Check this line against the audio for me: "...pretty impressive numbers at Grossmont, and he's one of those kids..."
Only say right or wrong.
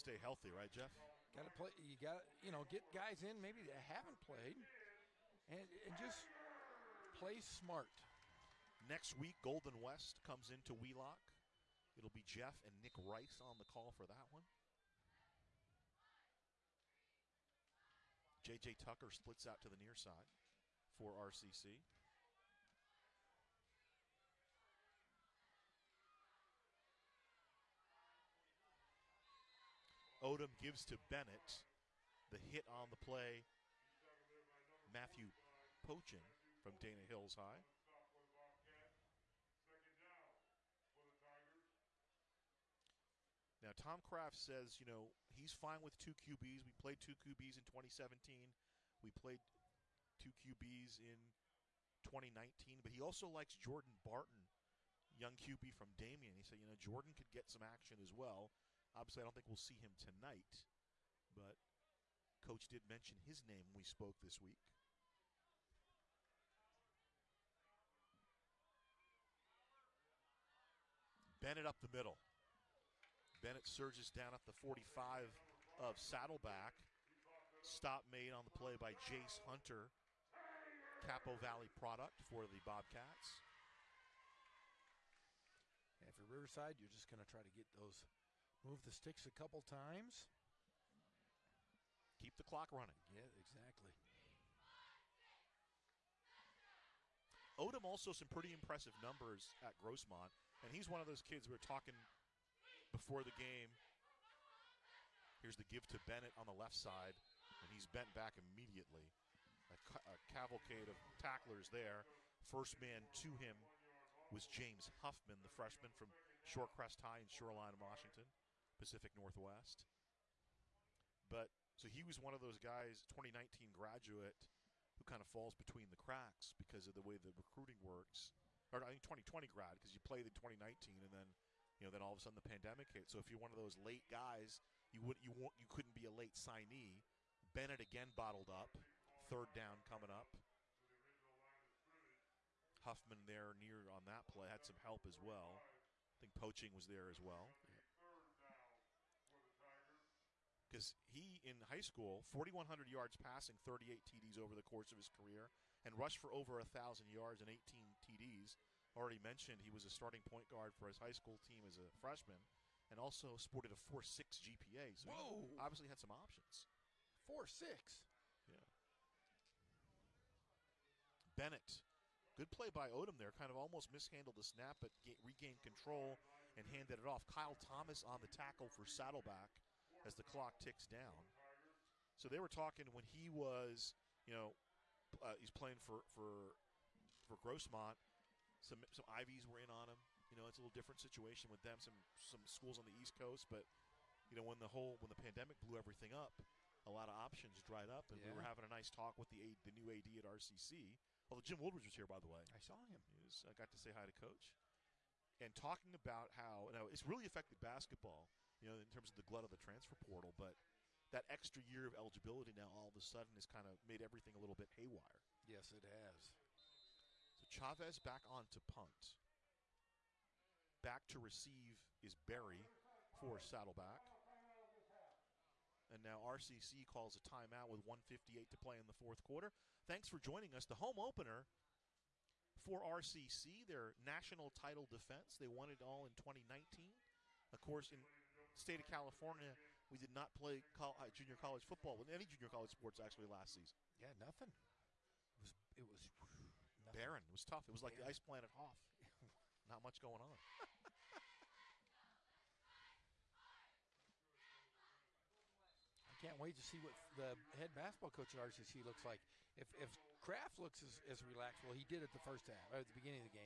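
right.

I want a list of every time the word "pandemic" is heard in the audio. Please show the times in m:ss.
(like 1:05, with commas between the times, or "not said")
2:12, 3:15.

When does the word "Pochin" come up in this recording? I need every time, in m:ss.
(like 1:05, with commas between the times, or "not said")
0:35, 2:26.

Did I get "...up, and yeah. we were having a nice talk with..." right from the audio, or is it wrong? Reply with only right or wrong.
right.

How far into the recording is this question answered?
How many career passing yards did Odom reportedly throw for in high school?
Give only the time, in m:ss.
2:32.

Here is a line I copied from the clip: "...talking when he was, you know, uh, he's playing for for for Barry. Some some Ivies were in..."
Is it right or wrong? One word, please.
wrong.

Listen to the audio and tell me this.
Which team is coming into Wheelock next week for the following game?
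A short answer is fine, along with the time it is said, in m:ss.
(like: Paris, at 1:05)
Golden West, at 0:09.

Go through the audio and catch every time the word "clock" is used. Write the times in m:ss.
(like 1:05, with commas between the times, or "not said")
1:32, 3:00.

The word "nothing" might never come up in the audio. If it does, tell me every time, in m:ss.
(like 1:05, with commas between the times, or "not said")
4:04.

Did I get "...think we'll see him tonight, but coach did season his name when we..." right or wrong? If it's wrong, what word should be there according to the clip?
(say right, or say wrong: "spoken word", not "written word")
wrong: "mention", not "season".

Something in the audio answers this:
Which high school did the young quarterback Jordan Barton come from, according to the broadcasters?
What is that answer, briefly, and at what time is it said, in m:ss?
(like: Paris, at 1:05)
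Damien, at 0:55.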